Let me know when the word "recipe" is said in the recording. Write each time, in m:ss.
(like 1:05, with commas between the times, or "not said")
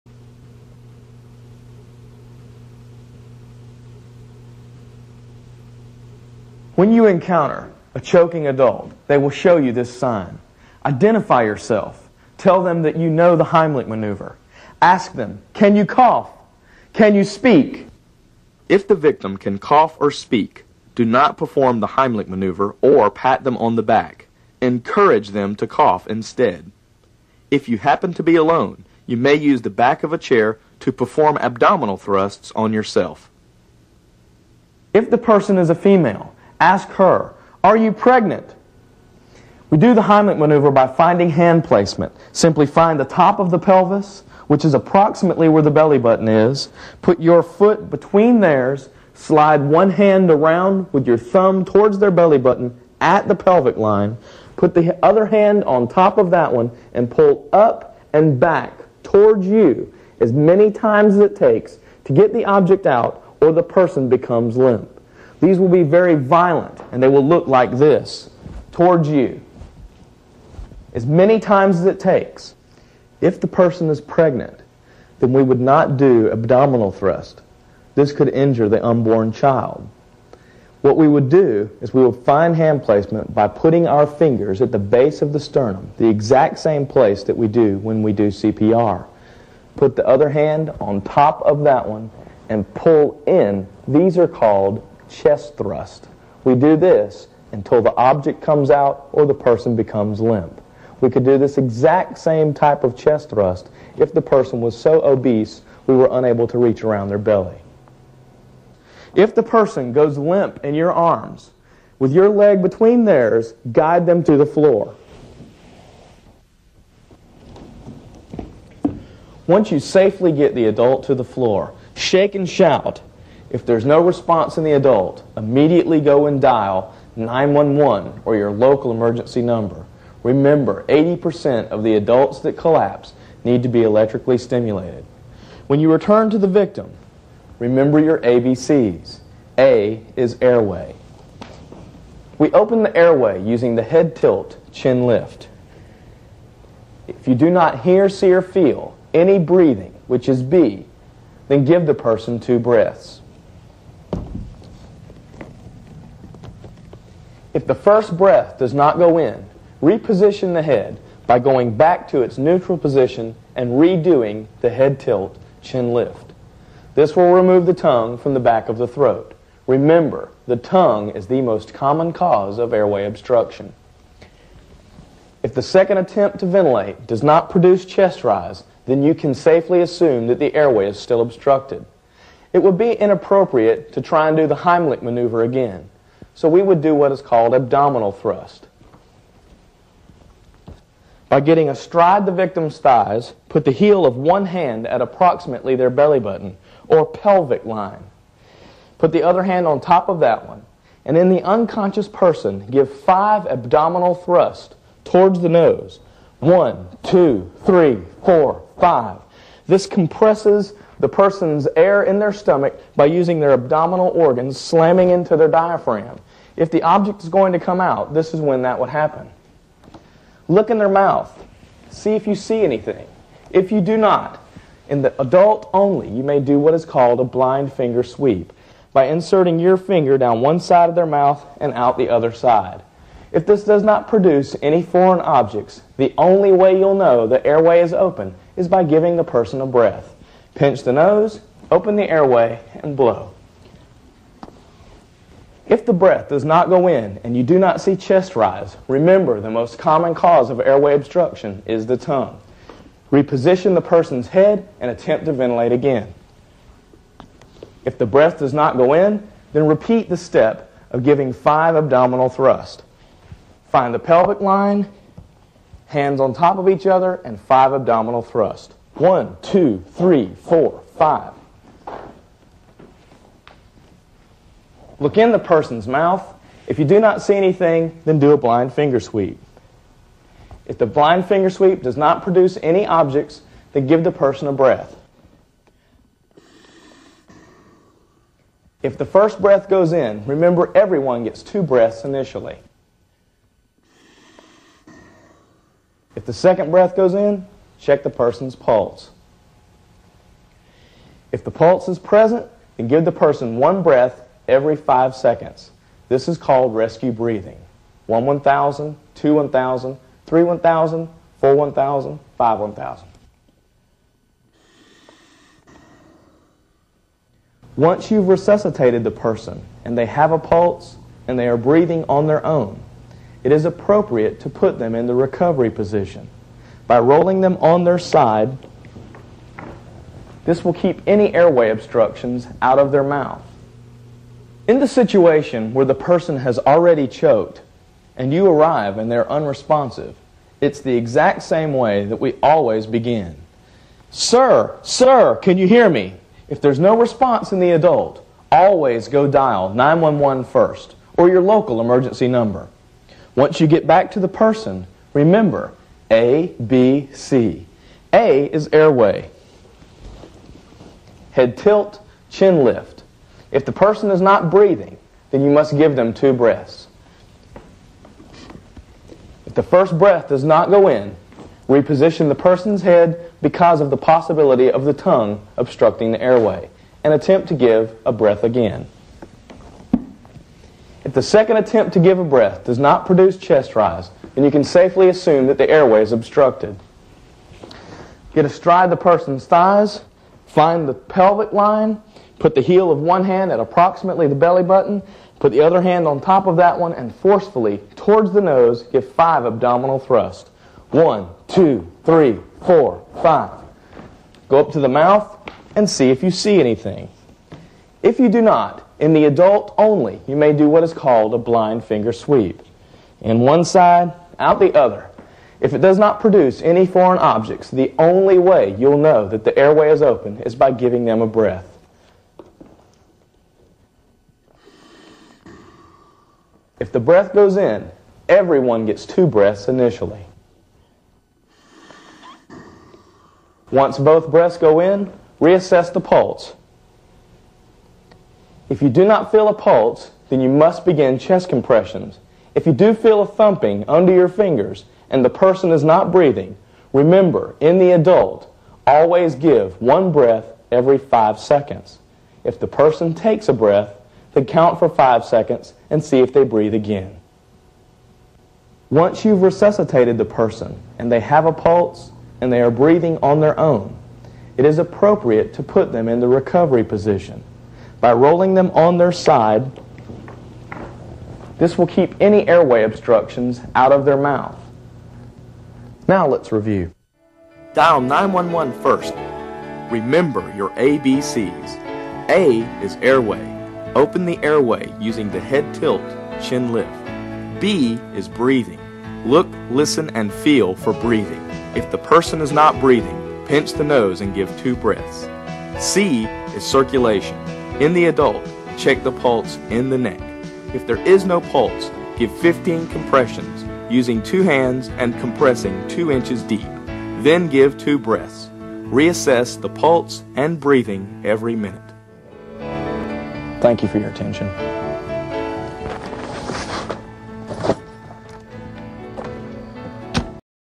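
not said.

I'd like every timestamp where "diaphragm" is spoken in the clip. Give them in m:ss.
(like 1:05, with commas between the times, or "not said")
3:35.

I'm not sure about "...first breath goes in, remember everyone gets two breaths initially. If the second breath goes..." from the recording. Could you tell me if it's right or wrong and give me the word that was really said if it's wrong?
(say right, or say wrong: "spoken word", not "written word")
right.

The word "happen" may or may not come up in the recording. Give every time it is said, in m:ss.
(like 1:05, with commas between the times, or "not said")
0:27, 3:38.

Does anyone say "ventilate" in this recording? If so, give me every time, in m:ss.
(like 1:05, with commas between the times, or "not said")
2:56, 4:15.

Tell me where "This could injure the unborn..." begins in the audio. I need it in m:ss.
1:17.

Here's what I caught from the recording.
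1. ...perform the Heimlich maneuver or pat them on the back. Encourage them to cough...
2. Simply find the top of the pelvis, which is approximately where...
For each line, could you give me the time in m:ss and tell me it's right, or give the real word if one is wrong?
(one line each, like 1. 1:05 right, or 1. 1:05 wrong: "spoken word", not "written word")
1. 0:21 right
2. 0:42 right.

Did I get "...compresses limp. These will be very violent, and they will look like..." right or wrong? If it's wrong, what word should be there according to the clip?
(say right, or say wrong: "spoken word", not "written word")
wrong: "becomes", not "compresses".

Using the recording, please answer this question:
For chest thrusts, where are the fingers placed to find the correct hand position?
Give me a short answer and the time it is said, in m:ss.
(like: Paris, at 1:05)
base of the sternum, at 1:24.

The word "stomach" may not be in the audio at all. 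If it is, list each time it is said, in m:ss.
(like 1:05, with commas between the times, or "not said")
3:32.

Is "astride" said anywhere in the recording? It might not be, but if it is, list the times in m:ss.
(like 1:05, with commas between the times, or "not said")
3:11, 6:28.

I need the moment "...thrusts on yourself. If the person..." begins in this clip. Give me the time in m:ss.
0:31.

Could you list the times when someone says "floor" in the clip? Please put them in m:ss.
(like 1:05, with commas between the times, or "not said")
1:54, 2:01.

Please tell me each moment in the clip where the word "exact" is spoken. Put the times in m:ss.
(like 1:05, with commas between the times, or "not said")
1:26, 1:41, 5:40.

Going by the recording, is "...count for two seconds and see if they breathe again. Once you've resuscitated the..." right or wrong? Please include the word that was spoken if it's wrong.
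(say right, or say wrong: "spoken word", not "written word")
wrong: "five", not "two".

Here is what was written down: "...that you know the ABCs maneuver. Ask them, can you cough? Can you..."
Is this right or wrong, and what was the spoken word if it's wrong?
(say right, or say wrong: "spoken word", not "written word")
wrong: "Heimlich", not "ABCs".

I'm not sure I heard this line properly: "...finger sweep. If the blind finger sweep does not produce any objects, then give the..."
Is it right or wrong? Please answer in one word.
right.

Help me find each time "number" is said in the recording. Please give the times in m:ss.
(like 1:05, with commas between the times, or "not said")
2:09, 5:52.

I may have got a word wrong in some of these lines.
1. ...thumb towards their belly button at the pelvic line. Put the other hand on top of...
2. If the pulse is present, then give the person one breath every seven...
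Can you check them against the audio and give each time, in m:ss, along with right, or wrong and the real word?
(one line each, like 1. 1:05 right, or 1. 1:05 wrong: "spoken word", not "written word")
1. 0:51 right
2. 5:01 wrong: "five", not "seven".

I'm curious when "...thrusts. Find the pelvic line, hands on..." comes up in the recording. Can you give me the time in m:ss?
4:22.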